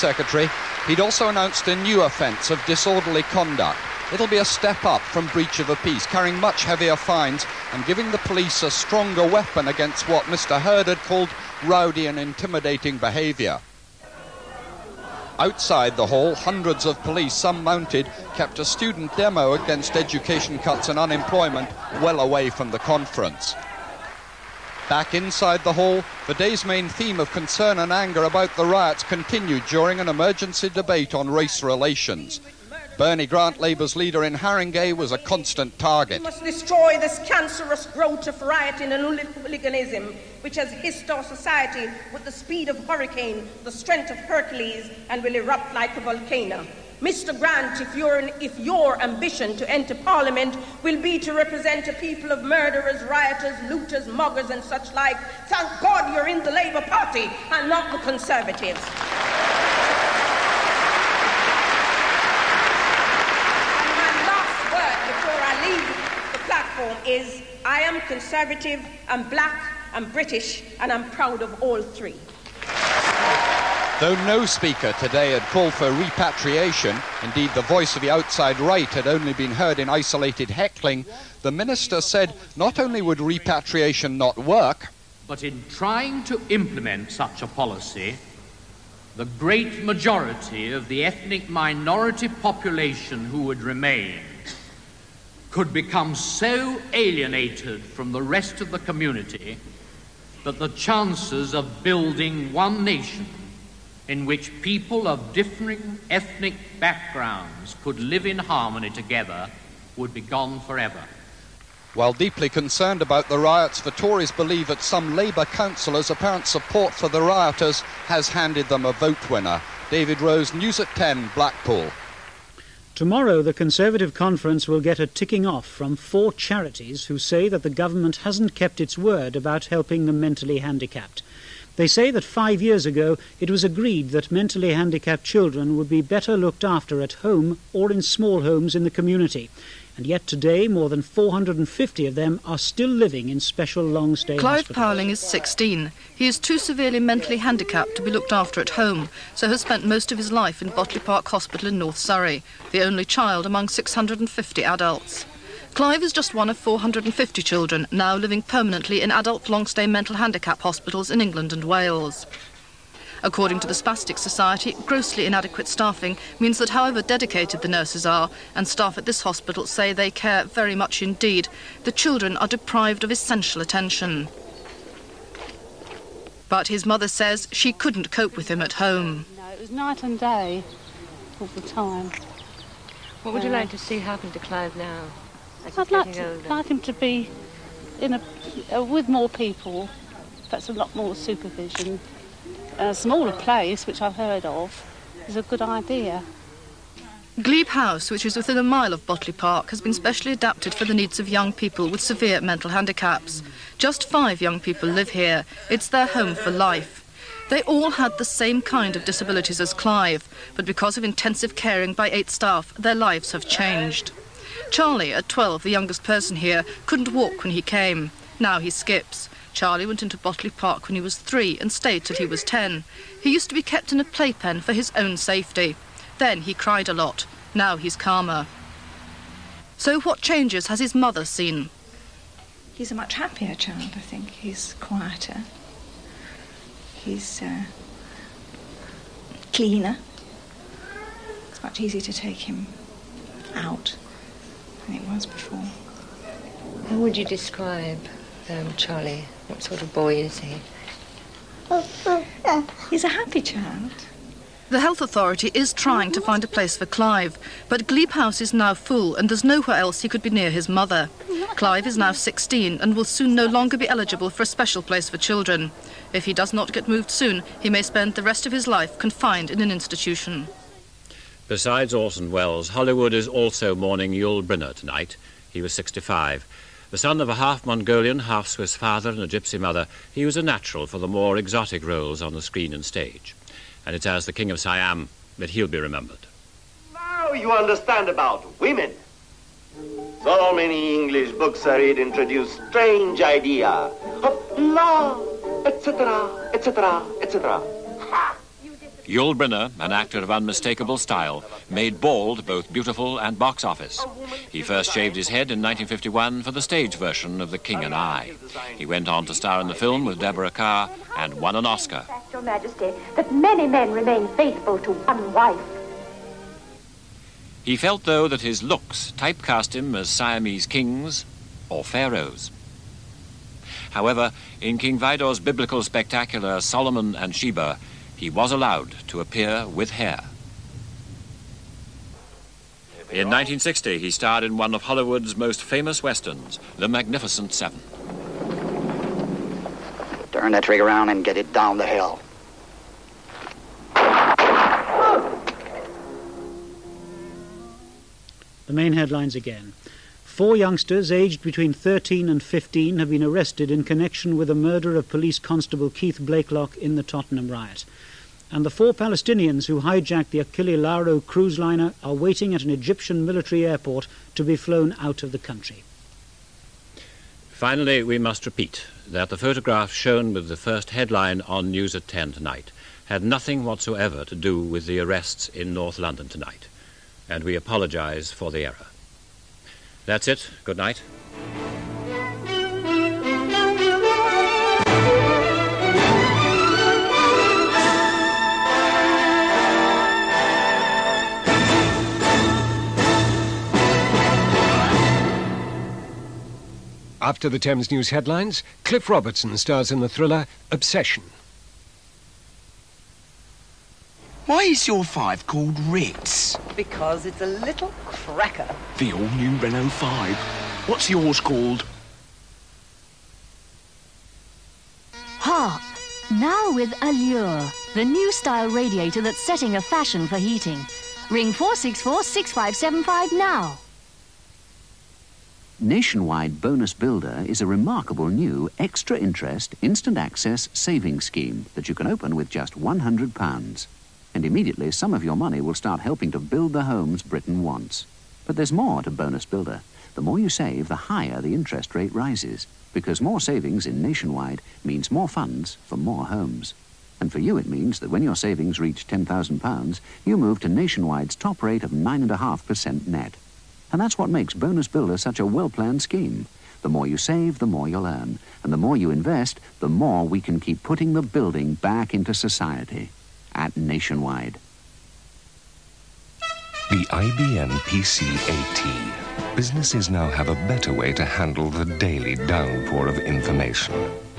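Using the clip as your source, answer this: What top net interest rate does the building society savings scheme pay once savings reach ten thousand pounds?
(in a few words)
9.5%.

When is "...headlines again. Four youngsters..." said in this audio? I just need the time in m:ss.
5:48.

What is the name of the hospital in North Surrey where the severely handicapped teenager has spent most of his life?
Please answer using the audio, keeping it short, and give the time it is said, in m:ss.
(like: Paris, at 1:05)
Botley Park Hospital, at 2:30.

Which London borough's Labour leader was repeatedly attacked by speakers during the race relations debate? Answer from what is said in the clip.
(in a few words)
Haringey.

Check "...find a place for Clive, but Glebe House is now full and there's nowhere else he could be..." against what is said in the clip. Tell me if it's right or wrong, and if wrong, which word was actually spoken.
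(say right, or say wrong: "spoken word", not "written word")
right.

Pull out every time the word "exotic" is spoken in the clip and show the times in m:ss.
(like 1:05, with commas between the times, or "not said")
4:41.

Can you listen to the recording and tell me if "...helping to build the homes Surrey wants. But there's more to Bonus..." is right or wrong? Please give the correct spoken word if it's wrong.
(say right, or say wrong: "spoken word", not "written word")
wrong: "Britain", not "Surrey".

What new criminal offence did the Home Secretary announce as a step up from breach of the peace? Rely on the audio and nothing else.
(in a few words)
Disorderly conduct.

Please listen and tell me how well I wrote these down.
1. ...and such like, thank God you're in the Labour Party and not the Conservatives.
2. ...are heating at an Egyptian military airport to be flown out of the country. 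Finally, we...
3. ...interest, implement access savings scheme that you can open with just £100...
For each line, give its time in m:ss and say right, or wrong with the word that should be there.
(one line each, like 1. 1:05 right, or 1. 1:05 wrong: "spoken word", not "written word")
1. 0:54 right
2. 6:02 wrong: "waiting", not "heating"
3. 7:09 wrong: "instant", not "implement".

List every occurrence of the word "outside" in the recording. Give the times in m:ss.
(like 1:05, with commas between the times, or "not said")
0:15, 1:18.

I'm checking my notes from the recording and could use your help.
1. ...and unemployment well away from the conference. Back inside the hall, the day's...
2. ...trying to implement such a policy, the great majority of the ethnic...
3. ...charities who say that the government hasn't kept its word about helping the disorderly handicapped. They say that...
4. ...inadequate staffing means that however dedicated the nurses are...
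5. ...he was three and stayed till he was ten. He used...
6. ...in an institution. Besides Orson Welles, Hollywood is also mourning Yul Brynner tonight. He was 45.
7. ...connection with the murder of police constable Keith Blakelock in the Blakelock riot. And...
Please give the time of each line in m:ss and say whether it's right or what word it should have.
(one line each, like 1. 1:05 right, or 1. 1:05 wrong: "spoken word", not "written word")
1. 0:20 right
2. 1:25 right
3. 2:06 wrong: "mentally", not "disorderly"
4. 2:45 right
5. 3:40 right
6. 4:29 wrong: "65", not "45"
7. 5:53 wrong: "Tottenham", not "Blakelock".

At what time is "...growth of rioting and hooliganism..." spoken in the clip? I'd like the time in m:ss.
0:37.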